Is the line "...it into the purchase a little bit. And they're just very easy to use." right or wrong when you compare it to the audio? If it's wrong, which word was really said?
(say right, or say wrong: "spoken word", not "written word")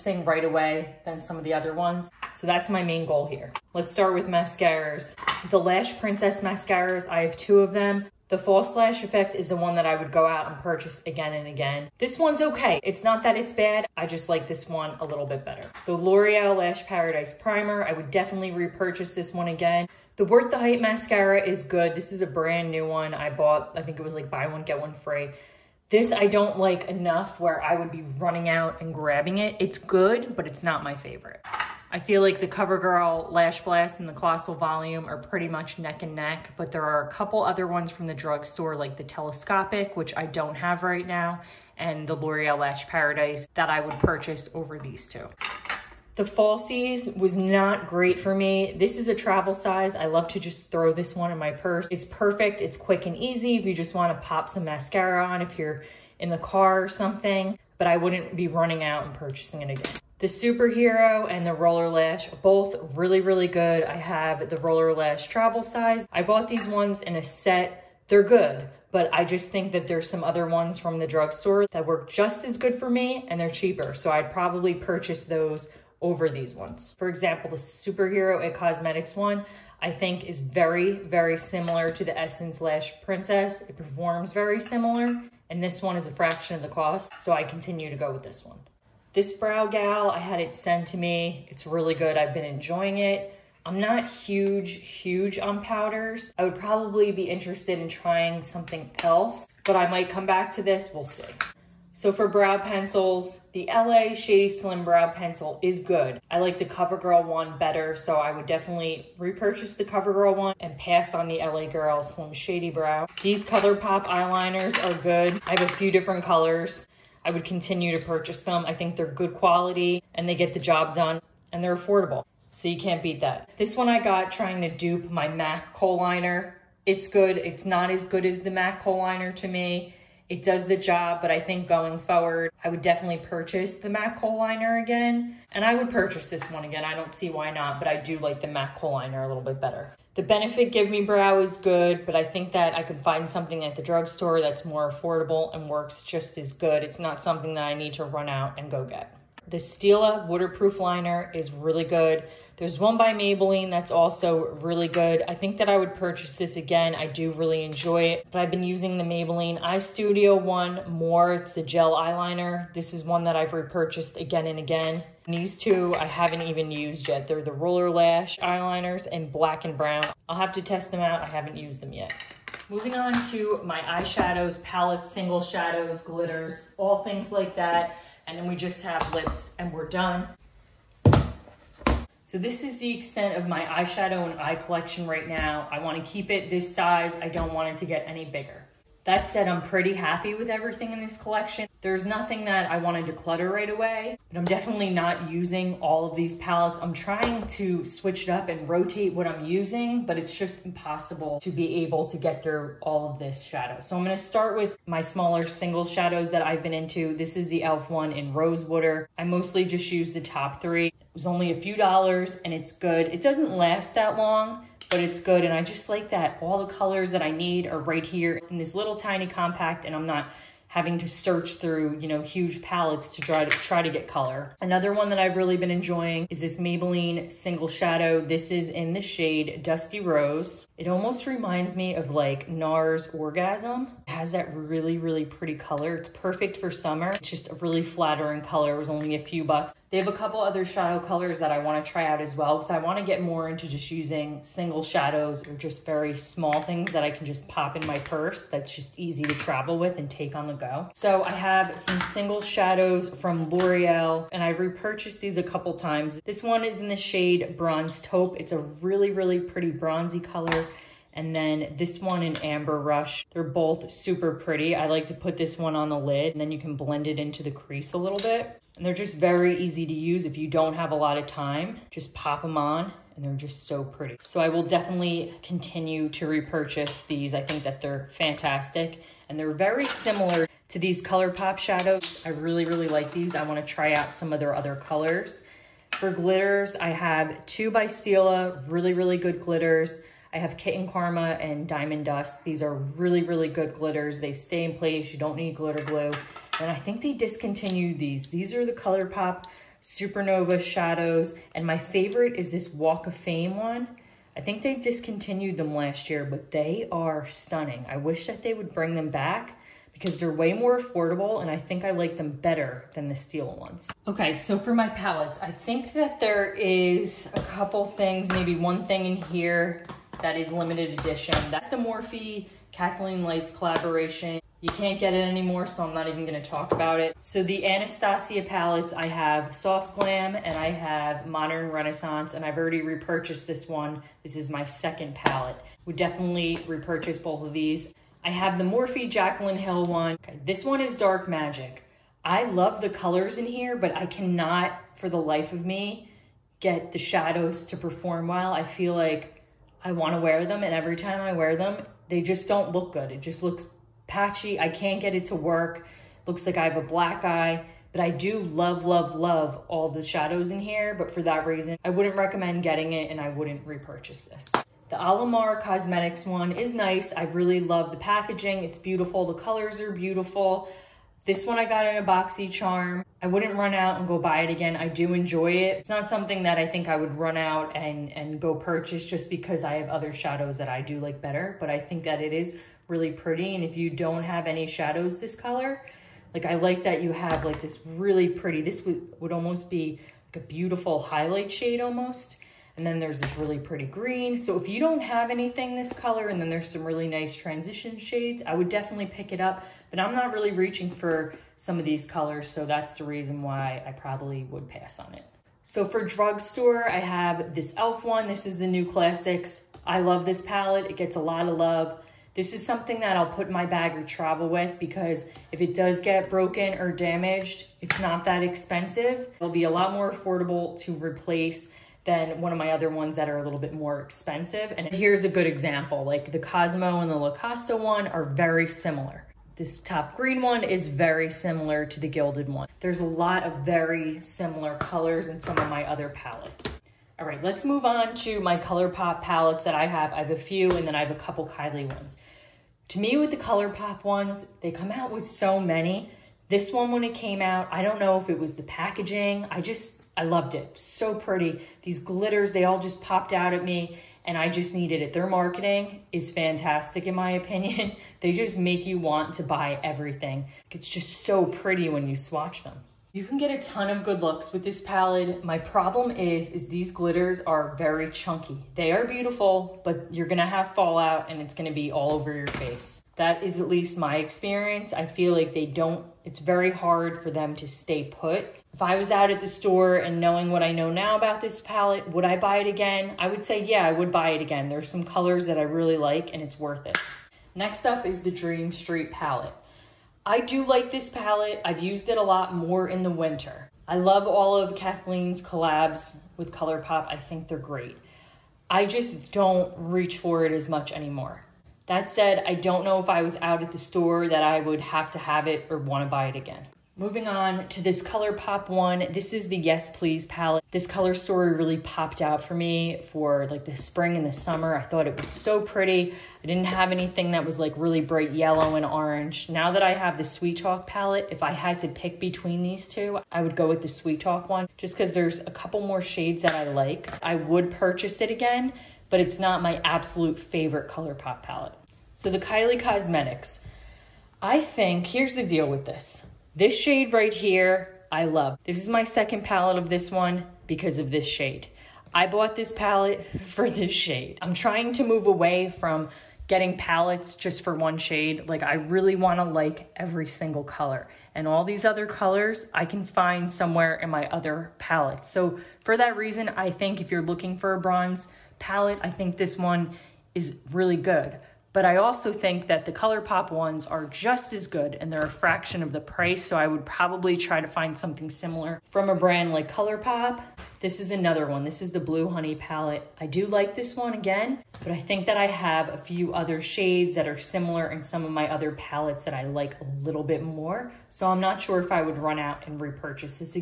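wrong: "crease", not "purchase".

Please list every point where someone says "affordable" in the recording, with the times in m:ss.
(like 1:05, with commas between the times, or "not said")
2:01, 2:24, 5:10, 7:00.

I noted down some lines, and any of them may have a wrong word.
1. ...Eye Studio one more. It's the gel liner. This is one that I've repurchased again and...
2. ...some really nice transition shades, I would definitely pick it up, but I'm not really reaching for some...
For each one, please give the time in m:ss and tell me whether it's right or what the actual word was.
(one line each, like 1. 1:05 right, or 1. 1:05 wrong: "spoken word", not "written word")
1. 2:39 wrong: "eyeliner", not "liner"
2. 6:36 right.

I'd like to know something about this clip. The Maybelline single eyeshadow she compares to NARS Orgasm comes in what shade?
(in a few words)
Dusty Rose.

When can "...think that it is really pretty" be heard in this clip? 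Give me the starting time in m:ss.
6:21.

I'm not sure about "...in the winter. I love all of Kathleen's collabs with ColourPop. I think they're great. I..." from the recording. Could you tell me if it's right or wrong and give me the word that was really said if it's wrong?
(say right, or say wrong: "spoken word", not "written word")
right.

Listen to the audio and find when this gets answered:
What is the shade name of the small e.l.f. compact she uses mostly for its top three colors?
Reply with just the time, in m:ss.
3:28.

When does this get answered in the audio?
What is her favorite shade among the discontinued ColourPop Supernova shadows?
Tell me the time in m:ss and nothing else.
5:02.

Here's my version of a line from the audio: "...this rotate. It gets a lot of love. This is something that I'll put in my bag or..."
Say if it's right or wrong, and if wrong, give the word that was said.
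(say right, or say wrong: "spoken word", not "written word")
wrong: "palette", not "rotate".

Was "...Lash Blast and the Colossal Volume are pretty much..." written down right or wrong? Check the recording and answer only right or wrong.
right.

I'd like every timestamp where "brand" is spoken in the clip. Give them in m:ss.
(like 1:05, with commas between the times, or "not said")
0:22, 9:29.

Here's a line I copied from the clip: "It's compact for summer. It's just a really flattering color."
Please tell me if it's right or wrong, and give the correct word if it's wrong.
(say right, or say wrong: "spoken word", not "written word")
wrong: "perfect", not "compact".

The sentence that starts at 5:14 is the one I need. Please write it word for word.
Okay, so for my palettes, I think that there is a couple things, maybe one thing in here that is limited edition.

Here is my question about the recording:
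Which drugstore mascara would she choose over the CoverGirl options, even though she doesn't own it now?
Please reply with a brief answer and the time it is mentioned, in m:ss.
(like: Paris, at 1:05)
Telescopic, at 0:39.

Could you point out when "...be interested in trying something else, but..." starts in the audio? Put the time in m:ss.
1:37.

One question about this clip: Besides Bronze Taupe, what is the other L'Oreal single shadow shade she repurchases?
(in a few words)
Amber Rush.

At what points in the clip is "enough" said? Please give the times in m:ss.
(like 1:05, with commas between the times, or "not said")
0:26.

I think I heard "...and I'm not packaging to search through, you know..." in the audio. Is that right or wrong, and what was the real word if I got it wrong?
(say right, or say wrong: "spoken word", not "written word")
wrong: "having", not "packaging".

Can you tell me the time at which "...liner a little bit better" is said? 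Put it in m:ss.
2:18.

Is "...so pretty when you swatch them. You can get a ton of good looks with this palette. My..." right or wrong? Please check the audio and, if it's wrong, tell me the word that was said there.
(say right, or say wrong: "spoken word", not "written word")
right.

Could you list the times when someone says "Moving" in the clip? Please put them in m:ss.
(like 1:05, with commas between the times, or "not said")
2:52, 8:26.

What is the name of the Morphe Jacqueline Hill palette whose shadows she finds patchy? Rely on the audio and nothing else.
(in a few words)
Dark Magic.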